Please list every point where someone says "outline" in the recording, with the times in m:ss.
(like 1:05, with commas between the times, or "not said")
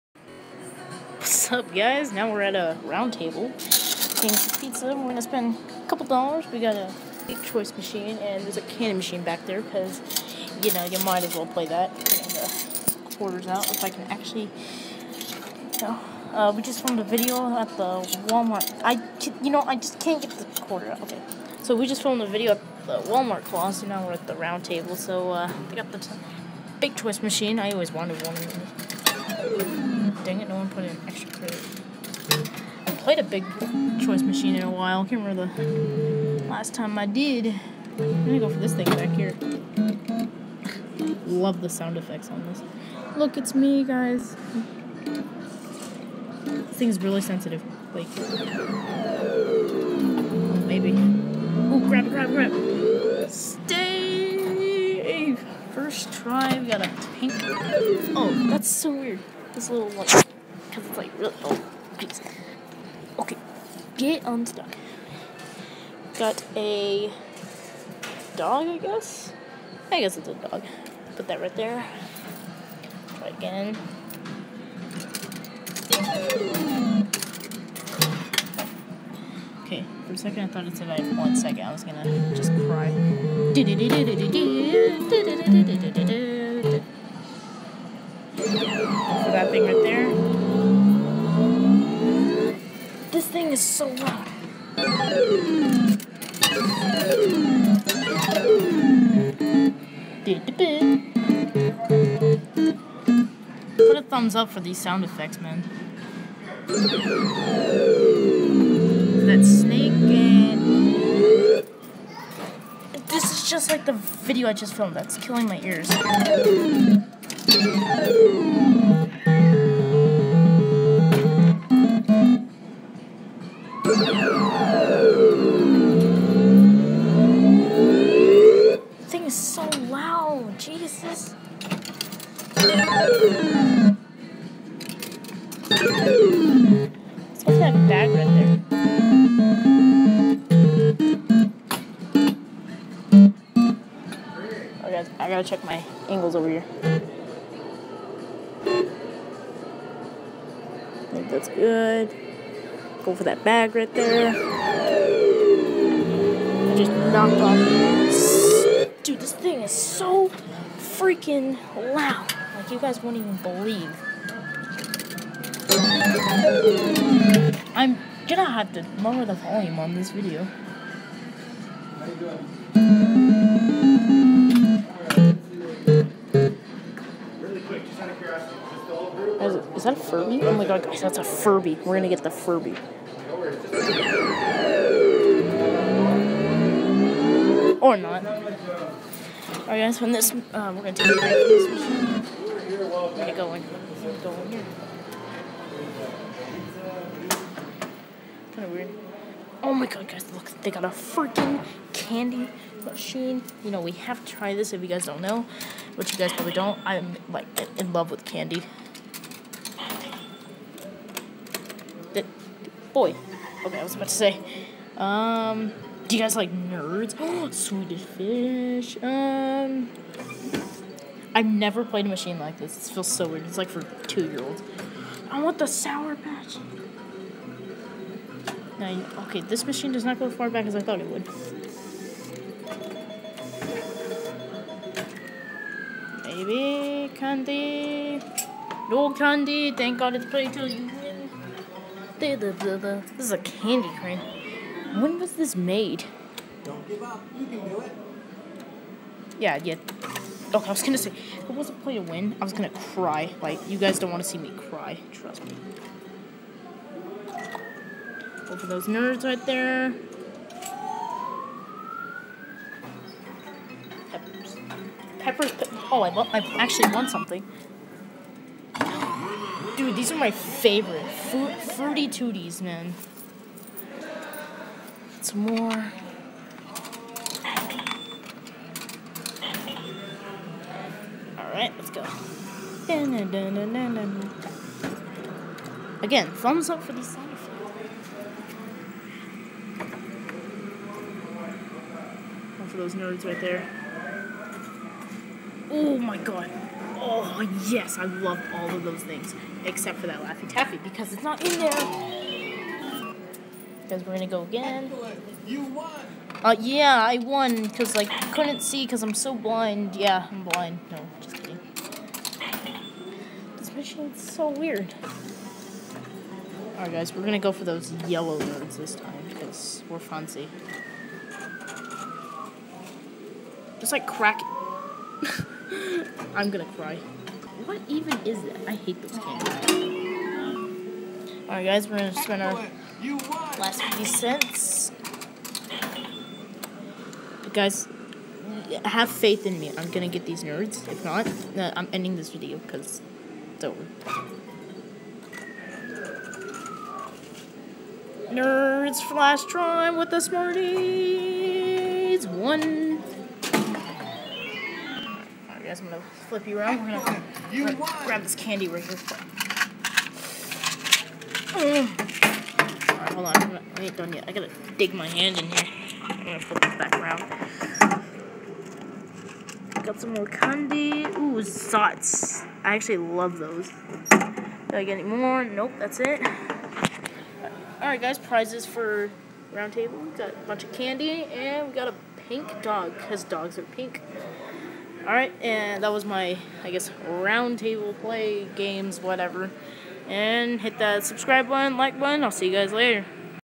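not said.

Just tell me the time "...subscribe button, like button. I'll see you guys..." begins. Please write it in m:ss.
6:31.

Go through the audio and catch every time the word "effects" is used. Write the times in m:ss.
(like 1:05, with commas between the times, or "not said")
0:41, 1:45.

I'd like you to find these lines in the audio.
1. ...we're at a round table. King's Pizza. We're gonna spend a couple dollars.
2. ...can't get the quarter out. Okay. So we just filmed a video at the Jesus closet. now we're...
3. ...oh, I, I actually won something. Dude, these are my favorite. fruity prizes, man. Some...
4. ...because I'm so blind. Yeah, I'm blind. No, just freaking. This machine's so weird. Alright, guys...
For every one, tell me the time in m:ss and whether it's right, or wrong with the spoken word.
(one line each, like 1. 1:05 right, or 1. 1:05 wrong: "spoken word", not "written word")
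1. 0:02 right
2. 0:19 wrong: "Walmart", not "Jesus"
3. 4:25 wrong: "tooties", not "prizes"
4. 5:08 wrong: "kidding", not "freaking".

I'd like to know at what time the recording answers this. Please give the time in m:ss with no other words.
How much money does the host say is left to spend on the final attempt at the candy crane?
5:33.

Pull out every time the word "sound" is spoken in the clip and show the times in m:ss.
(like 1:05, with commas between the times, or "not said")
0:41, 1:44, 4:47.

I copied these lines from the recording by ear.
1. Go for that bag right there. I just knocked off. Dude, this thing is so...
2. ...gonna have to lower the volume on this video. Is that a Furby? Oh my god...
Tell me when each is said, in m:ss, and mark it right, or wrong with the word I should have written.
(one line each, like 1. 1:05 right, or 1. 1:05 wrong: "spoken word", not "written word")
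1. 2:33 right
2. 2:48 right.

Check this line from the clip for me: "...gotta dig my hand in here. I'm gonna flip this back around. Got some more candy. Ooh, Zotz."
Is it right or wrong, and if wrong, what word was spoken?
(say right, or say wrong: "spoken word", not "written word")
right.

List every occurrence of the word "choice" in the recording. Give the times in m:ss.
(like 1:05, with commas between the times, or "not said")
0:07, 0:26, 0:34.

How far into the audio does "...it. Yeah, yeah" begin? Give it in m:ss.
4:07.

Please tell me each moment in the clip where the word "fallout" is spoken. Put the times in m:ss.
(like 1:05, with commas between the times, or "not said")
not said.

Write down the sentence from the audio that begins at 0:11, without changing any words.
Uh, quarters out if I can actually.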